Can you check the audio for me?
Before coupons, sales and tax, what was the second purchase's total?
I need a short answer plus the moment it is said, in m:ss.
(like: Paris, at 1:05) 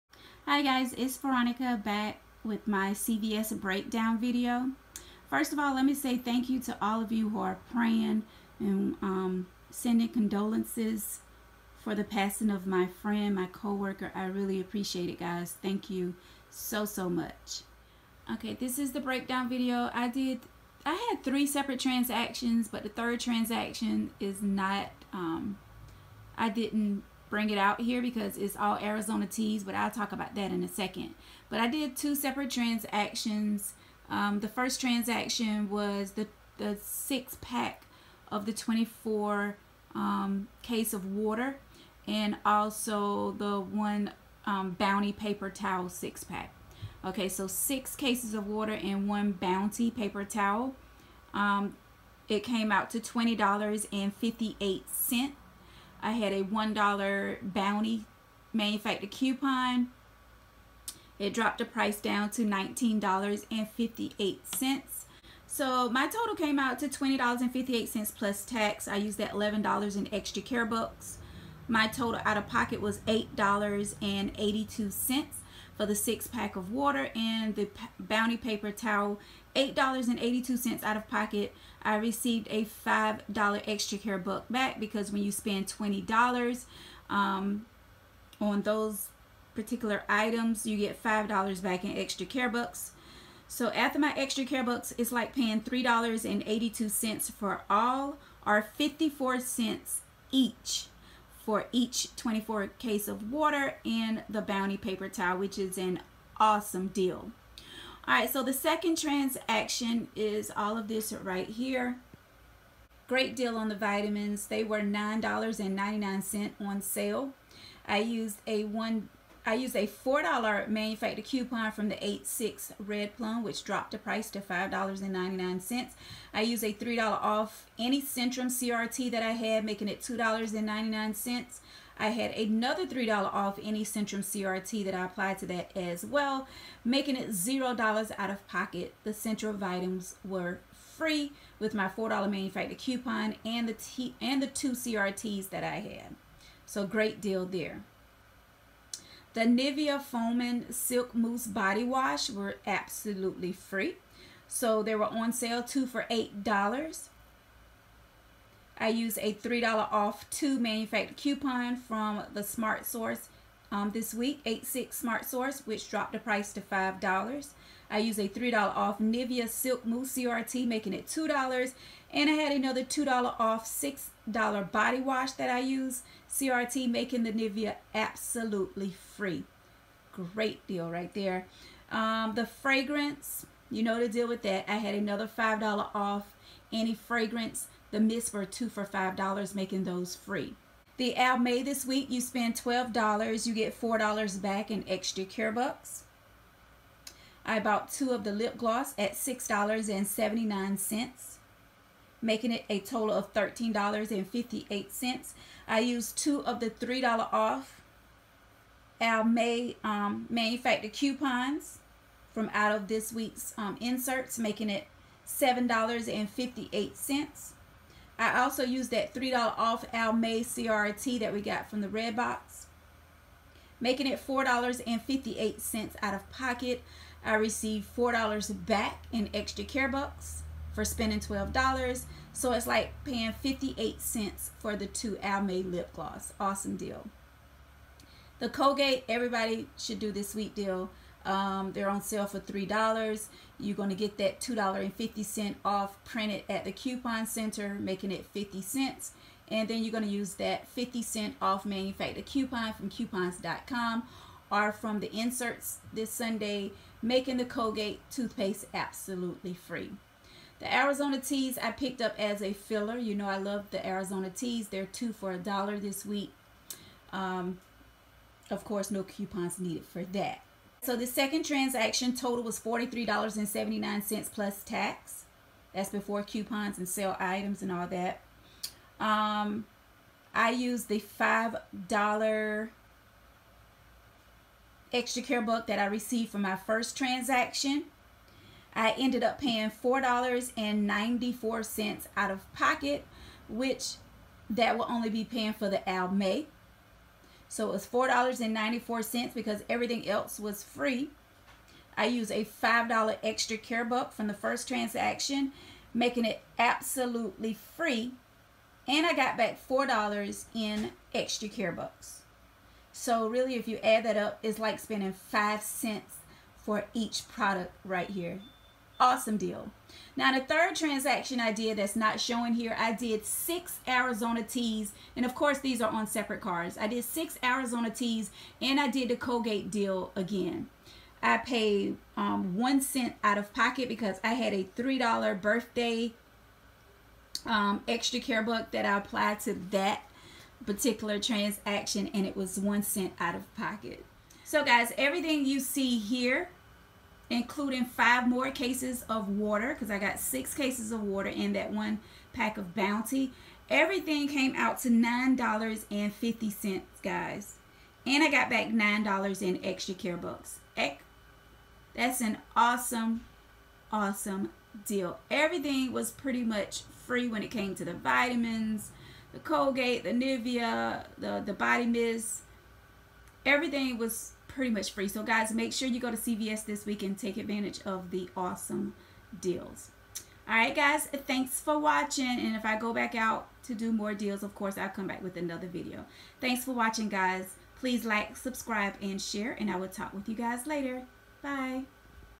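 $43.79, at 4:32.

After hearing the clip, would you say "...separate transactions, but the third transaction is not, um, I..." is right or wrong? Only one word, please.
right.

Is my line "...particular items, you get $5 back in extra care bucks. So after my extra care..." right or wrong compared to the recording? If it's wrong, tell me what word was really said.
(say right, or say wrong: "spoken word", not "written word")
right.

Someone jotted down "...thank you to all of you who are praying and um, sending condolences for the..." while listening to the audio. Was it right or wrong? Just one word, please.
right.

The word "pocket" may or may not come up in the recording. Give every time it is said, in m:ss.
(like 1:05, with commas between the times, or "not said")
1:21, 2:18, 3:46, 4:52, 5:33, 5:43.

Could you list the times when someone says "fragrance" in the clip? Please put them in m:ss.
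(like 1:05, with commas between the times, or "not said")
3:02, 3:06.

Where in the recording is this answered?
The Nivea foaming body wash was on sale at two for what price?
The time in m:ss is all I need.
2:35.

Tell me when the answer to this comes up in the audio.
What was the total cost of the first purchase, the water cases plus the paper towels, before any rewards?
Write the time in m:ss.
0:52.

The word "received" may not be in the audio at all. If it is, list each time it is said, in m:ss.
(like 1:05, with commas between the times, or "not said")
1:21, 3:47, 4:45.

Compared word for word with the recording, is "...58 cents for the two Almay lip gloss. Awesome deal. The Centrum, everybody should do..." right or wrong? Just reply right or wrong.
wrong.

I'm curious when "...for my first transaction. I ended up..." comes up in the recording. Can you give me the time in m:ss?
4:46.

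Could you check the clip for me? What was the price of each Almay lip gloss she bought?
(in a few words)
$6.79.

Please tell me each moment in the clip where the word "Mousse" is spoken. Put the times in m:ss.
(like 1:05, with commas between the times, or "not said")
2:31, 2:49.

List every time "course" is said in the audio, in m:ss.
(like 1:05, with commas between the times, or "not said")
4:28, 5:25, 6:24.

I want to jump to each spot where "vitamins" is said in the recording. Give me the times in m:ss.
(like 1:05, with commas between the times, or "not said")
1:53, 6:07.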